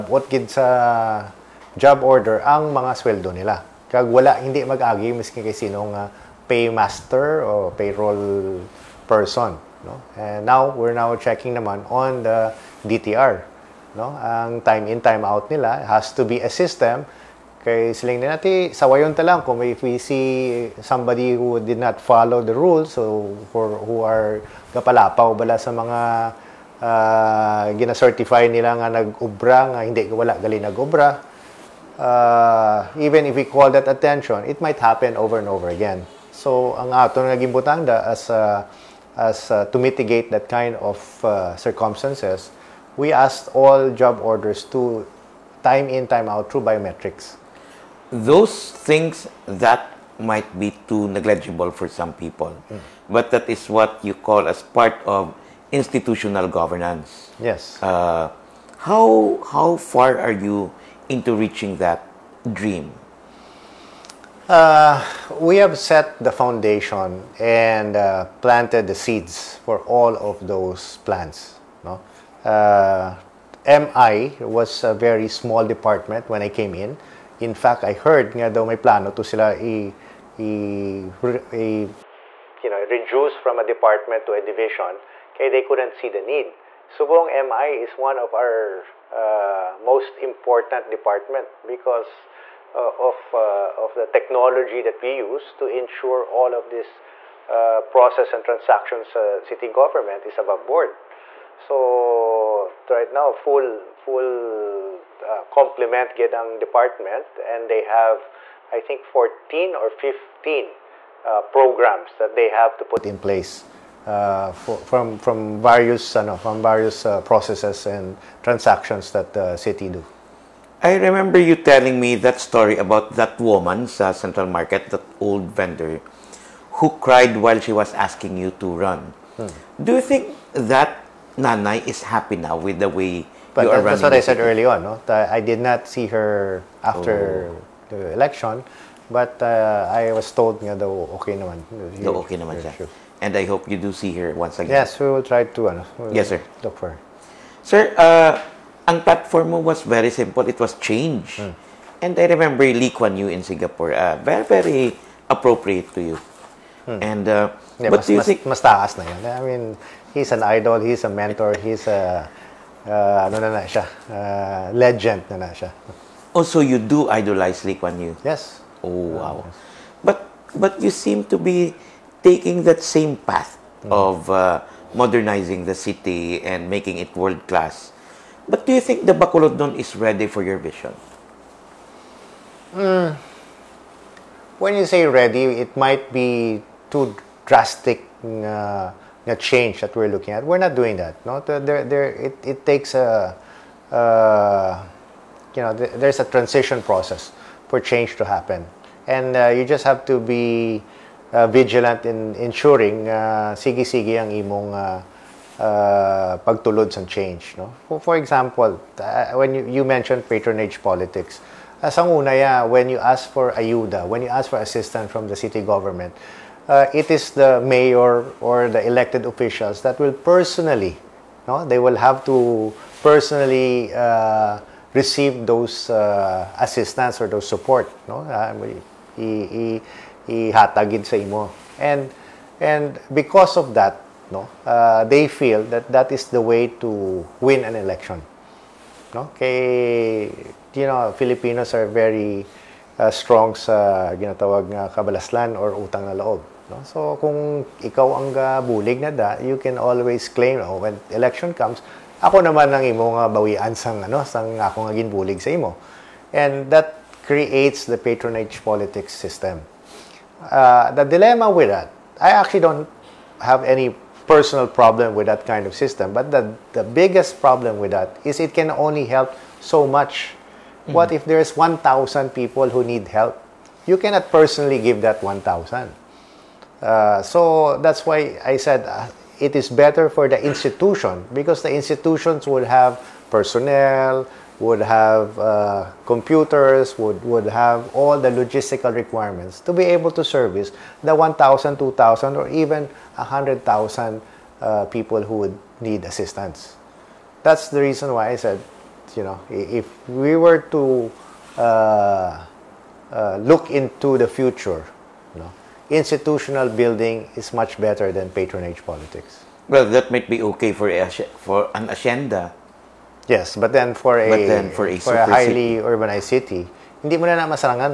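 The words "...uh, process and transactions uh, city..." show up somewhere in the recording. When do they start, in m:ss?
1:37.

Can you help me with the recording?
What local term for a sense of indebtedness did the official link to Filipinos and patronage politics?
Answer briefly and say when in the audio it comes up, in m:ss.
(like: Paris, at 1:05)
kabalaslan, at 4:04.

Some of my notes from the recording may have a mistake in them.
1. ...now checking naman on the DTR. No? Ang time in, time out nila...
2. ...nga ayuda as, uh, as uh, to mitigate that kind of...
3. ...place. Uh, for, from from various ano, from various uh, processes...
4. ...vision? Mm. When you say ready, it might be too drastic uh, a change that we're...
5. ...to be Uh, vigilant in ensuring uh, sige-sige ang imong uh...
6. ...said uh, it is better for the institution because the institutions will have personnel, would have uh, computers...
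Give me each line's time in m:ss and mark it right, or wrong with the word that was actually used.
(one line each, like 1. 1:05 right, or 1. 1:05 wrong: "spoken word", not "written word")
1. 0:10 right
2. 0:37 wrong: "gimbutanda", not "ayuda"
3. 1:53 right
4. 3:00 right
5. 3:20 right
6. 4:38 right.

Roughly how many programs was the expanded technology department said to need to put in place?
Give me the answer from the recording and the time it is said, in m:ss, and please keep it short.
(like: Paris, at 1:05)
14 or 15, at 1:49.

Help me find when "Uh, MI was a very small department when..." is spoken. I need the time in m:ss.
1:12.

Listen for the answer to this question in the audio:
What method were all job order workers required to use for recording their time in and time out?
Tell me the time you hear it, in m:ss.
0:46.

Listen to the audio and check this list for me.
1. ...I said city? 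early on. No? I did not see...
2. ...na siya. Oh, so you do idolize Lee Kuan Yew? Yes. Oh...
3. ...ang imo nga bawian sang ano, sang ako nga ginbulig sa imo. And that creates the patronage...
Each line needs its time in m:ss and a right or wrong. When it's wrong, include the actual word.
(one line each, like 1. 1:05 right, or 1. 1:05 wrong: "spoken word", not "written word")
1. 2:14 right
2. 2:45 right
3. 4:12 right.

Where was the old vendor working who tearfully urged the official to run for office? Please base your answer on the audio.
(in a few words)
Central Market.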